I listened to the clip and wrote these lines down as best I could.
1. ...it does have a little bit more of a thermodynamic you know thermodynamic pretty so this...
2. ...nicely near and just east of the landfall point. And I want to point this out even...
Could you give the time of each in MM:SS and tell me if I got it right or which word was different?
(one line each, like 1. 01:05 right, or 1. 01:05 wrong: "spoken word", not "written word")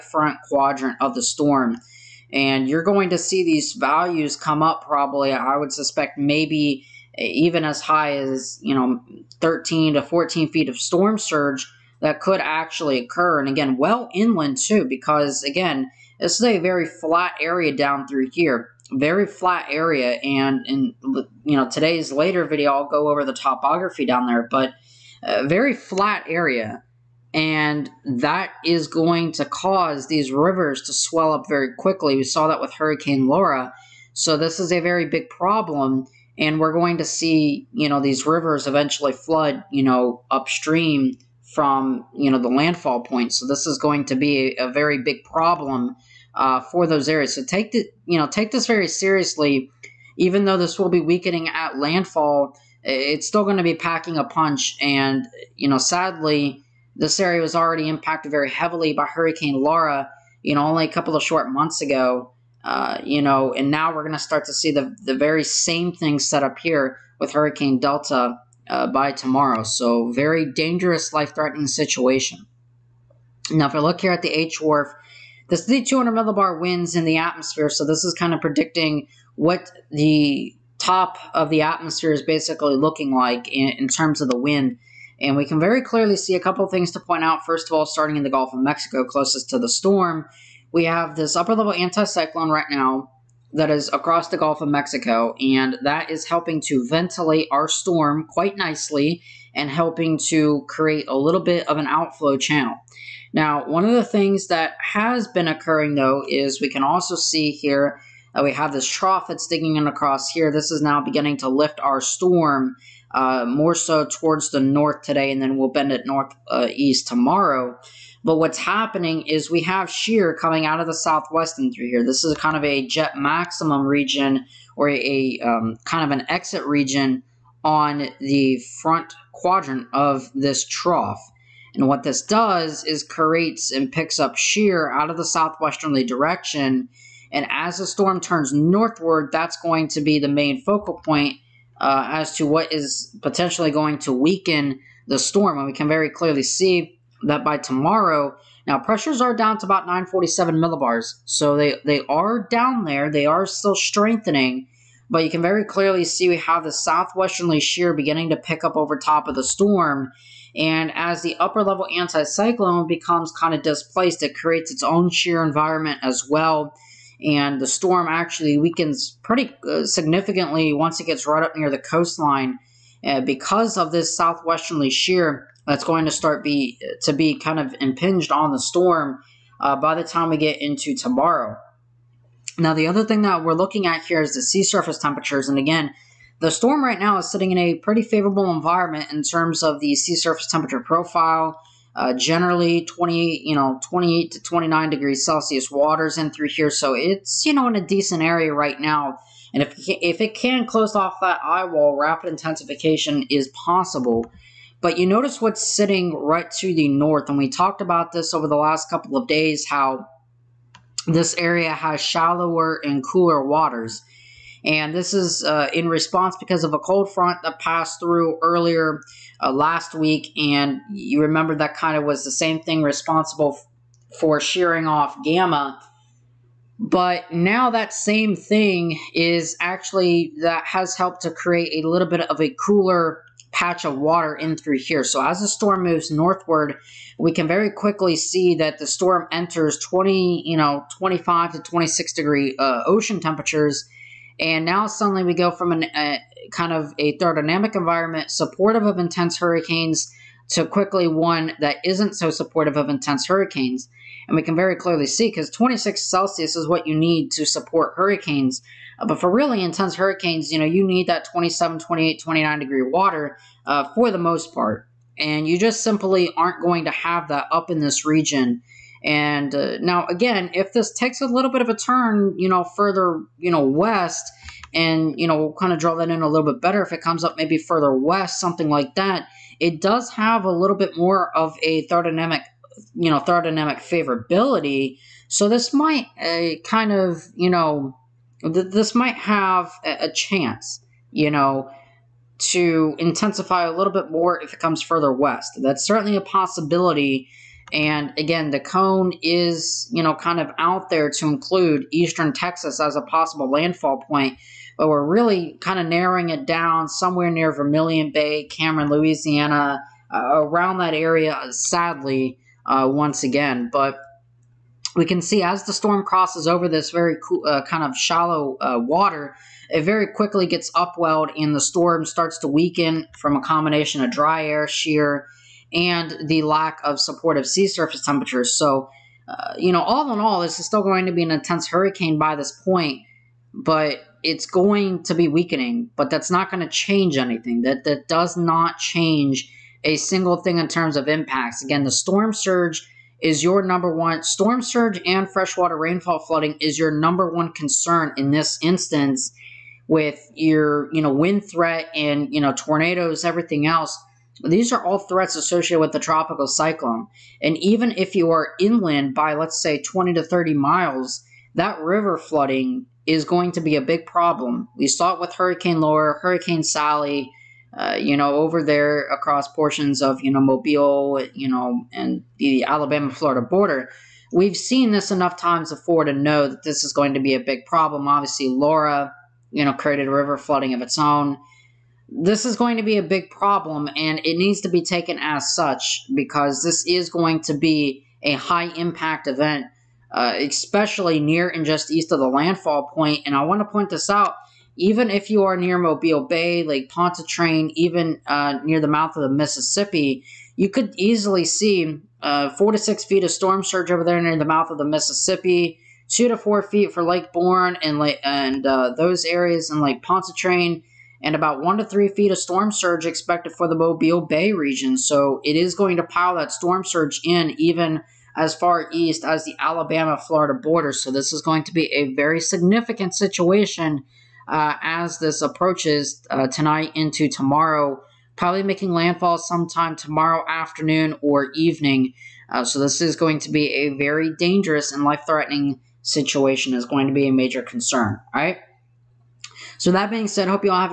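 1. 04:39 wrong: "favorability", not "pretty"
2. 06:30 wrong: "especially", not "nicely".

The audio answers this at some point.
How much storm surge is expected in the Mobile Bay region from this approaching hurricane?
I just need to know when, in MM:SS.
06:51.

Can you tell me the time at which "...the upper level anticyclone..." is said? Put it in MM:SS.
02:41.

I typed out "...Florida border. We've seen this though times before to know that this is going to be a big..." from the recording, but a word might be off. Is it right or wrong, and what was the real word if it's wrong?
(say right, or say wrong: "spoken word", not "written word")
wrong: "enough", not "though".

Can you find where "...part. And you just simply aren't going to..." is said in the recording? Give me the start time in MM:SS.
04:24.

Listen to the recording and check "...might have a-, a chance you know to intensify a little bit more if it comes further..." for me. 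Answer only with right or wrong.
right.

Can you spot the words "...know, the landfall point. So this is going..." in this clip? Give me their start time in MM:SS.
00:42.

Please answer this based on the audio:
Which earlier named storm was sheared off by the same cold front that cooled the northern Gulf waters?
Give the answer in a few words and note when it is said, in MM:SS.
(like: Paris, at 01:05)
Gamma, at 03:45.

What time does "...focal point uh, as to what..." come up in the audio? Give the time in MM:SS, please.
02:20.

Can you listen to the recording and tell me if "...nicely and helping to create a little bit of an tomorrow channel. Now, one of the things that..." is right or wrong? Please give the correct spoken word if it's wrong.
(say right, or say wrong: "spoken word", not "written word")
wrong: "outflow", not "tomorrow".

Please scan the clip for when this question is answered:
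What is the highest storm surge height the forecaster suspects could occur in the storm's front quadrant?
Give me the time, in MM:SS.
00:09.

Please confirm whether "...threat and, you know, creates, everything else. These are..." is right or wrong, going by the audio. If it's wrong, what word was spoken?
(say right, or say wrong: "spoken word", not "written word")
wrong: "tornadoes", not "creates".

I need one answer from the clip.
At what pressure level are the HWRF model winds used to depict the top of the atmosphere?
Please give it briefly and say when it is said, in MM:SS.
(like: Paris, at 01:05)
200 millibar, at 01:15.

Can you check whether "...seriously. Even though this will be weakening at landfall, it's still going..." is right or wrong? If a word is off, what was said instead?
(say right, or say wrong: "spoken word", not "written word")
right.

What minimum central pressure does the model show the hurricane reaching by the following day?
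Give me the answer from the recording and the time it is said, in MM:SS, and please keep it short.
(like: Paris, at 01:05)
947 millibars, at 02:29.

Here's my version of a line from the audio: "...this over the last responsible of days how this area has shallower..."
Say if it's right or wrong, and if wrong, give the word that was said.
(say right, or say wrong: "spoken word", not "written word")
wrong: "couple", not "responsible".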